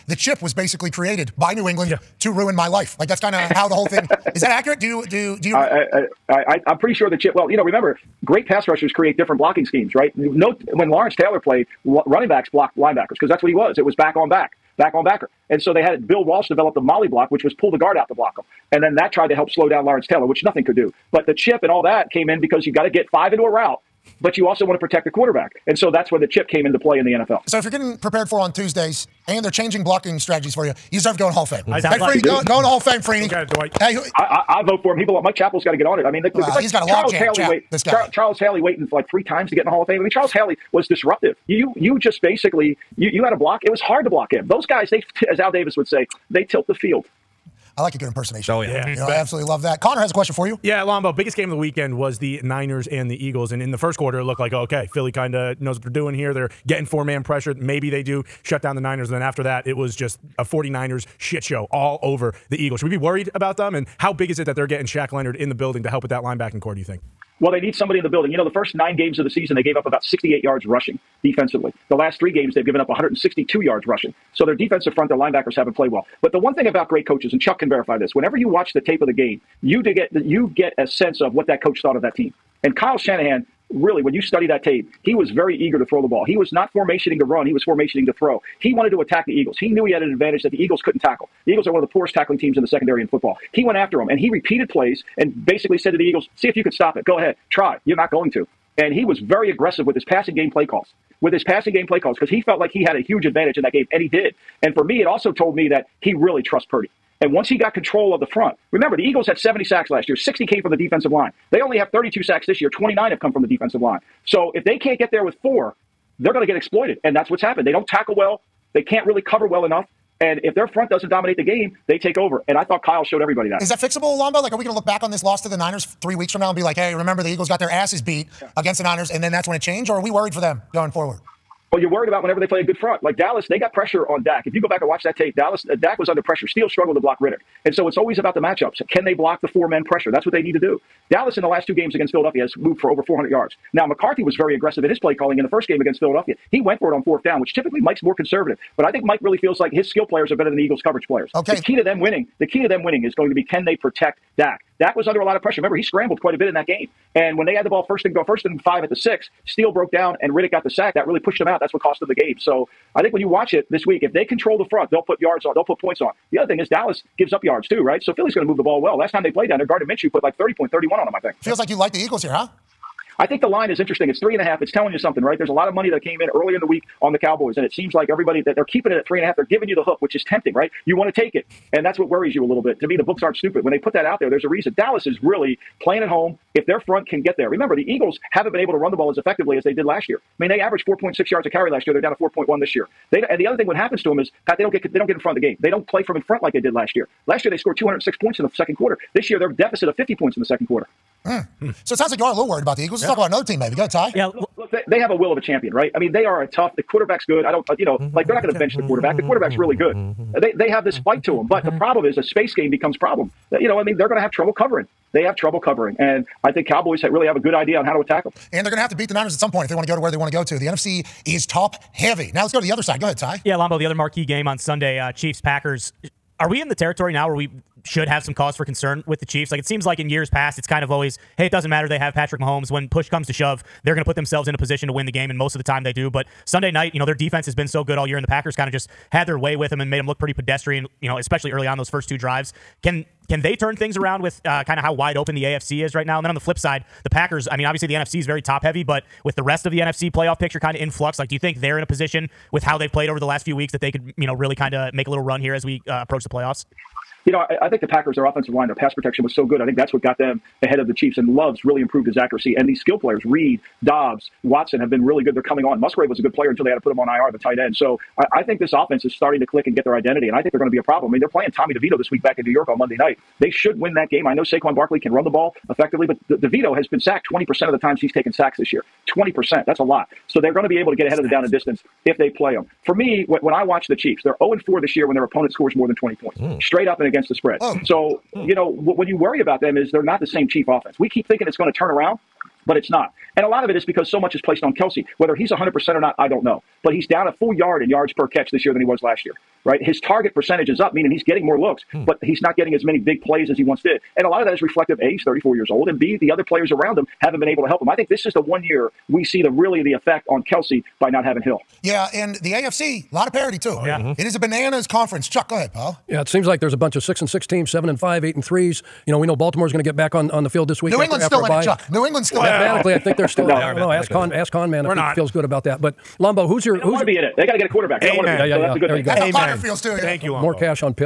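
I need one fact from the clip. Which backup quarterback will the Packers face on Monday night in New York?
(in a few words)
Tommy DeVito.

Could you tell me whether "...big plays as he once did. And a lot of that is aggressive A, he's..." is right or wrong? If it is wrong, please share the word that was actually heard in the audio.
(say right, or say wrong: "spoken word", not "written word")
wrong: "reflective", not "aggressive".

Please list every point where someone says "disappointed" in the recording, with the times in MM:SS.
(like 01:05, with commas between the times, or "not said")
not said.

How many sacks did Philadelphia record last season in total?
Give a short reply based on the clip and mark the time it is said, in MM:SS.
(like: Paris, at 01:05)
70, at 01:49.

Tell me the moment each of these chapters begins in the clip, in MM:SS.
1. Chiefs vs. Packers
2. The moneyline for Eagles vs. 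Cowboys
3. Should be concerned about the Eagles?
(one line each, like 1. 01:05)
1. 03:52
2. 03:00
3. 02:15.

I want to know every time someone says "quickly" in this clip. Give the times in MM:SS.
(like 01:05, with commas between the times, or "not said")
not said.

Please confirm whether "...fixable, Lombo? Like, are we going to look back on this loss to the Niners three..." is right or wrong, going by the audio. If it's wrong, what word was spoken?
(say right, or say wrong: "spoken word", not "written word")
right.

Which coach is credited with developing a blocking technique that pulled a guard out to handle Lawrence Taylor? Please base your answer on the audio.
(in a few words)
Bill Walsh.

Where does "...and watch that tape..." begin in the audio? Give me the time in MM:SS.
02:14.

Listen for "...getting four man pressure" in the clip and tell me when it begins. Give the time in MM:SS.
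00:56.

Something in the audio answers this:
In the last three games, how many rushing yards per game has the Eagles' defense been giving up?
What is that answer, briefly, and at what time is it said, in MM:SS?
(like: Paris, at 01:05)
162, at 01:12.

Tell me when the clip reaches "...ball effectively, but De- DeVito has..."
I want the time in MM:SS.
04:35.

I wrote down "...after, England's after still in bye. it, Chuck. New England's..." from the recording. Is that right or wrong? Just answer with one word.
right.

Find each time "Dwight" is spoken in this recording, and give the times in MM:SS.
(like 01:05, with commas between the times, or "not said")
00:33.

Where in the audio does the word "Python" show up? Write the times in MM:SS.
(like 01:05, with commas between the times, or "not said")
not said.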